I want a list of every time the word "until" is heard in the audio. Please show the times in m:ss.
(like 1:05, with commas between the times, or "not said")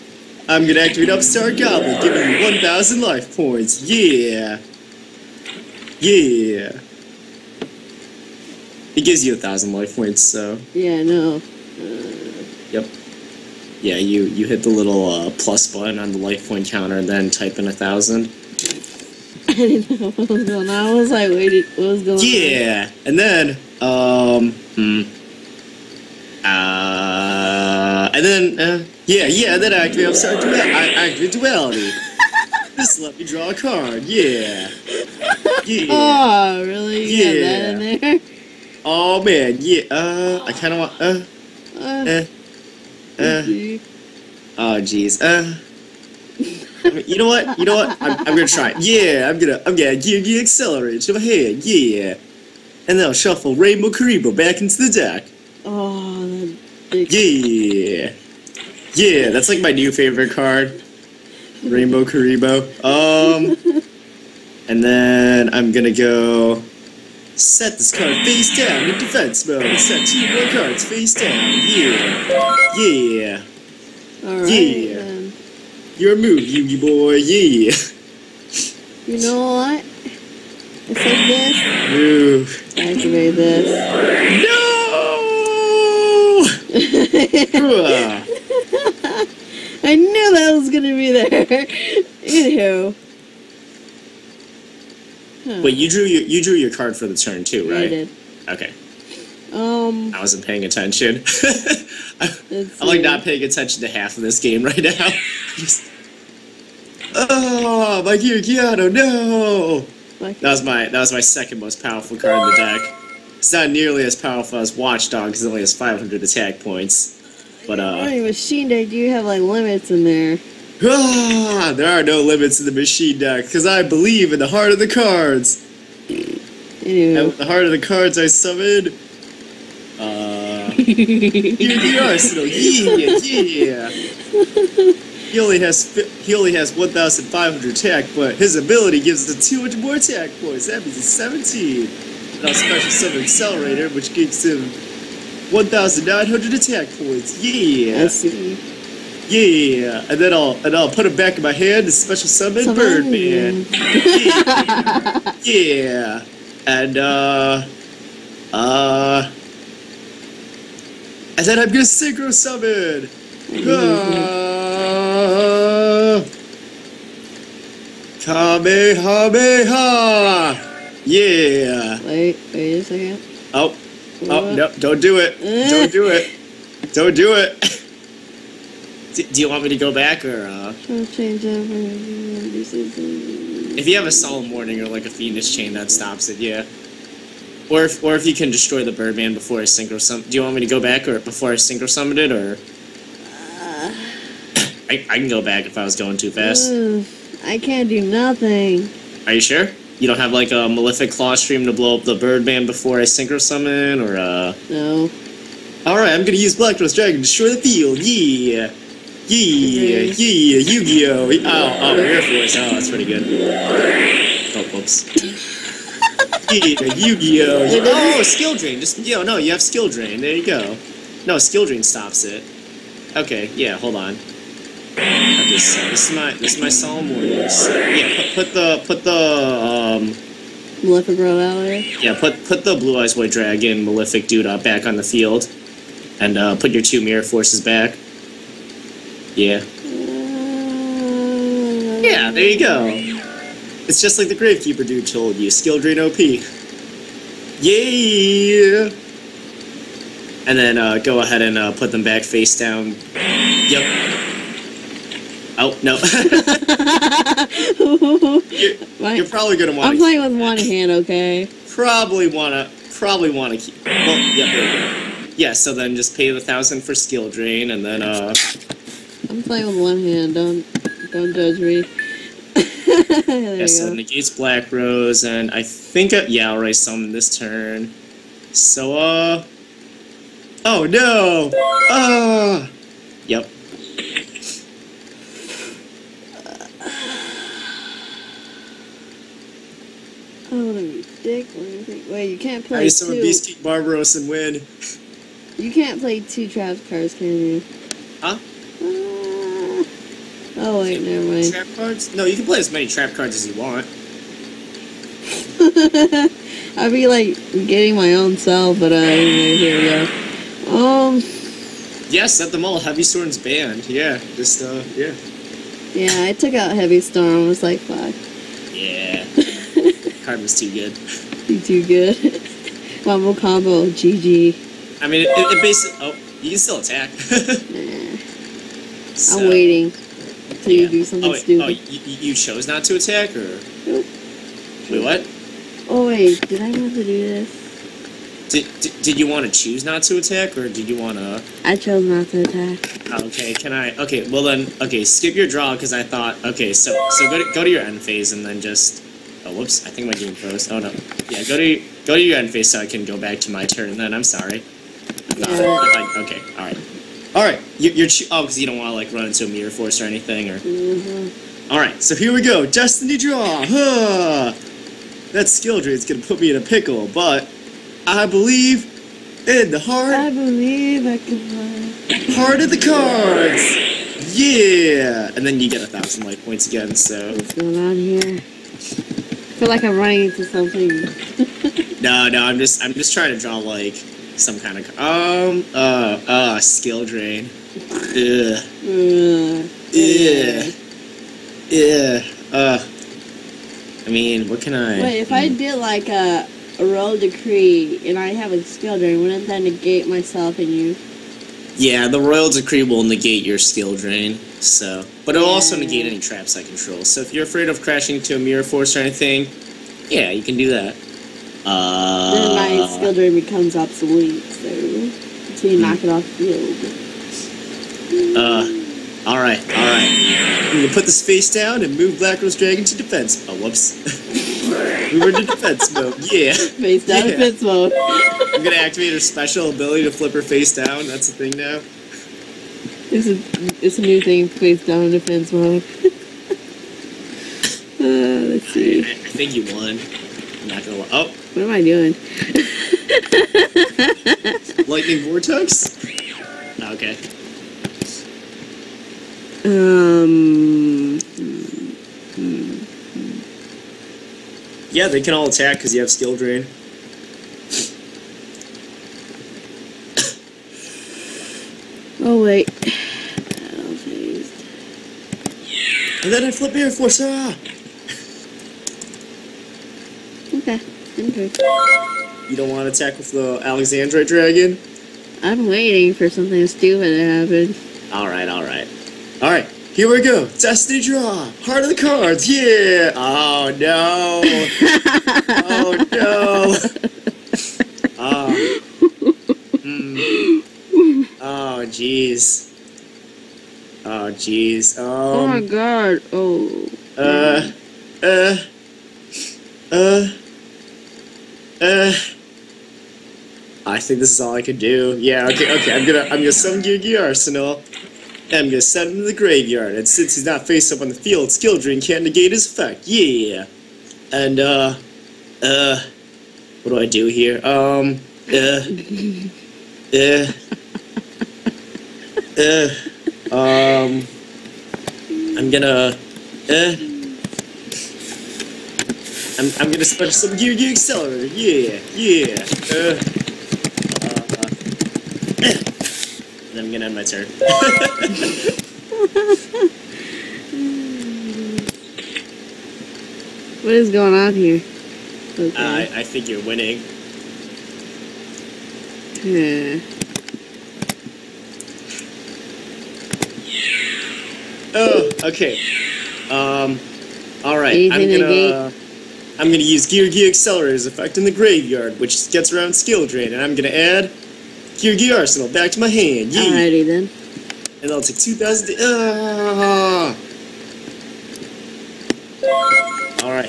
5:30, 6:54.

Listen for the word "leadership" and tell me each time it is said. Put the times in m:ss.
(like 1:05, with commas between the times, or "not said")
not said.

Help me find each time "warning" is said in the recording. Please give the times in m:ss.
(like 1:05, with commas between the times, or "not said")
3:04, 3:47.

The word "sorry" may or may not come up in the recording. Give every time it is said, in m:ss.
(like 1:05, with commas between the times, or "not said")
0:30, 5:54.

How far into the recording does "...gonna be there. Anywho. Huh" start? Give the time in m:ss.
1:30.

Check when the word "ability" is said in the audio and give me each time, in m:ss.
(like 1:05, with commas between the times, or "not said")
2:18, 7:09.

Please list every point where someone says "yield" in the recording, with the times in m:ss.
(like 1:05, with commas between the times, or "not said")
not said.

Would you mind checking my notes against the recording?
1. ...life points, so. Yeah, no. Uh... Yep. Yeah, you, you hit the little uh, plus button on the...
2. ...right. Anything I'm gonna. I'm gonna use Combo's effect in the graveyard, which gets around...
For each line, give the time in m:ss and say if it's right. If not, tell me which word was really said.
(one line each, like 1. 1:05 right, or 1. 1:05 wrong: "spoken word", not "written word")
1. 0:09 right
2. 9:17 wrong: "Geargiaccelerator", not "Combo".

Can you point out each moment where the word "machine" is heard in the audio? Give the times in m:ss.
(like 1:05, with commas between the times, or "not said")
1:58, 2:02.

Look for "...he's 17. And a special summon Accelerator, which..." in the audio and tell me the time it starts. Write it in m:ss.
2:20.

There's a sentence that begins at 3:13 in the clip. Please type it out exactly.
Uh, I, I can go back if I was going too fast.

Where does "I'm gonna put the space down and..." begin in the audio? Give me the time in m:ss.
7:00.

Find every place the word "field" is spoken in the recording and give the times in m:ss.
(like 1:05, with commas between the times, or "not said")
3:27, 3:55, 6:56, 8:31.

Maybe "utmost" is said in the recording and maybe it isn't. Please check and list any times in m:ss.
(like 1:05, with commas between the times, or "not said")
not said.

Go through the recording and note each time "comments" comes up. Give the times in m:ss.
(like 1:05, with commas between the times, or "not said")
not said.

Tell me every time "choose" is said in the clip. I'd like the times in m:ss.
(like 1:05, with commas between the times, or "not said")
5:39.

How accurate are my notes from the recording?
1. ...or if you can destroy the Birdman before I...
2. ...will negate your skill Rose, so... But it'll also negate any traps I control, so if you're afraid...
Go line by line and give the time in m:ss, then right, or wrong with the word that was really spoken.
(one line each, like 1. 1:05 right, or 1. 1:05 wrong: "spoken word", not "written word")
1. 3:08 right
2. 6:42 wrong: "Drain", not "Rose".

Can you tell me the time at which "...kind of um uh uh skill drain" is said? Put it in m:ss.
6:24.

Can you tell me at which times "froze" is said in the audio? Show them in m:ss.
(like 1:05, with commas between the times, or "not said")
5:50.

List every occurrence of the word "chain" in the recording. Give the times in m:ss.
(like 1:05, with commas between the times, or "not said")
3:05.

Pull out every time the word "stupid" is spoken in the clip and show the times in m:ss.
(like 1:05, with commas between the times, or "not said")
5:31, 7:56.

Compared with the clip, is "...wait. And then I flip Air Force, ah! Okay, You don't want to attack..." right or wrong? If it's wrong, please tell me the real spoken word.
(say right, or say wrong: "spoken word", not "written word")
right.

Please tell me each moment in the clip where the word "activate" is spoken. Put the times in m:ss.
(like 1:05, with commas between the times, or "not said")
0:00, 1:22, 7:08.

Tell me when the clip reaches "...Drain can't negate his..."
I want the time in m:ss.
8:31.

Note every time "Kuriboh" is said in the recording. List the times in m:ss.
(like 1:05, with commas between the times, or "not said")
0:53, 1:02.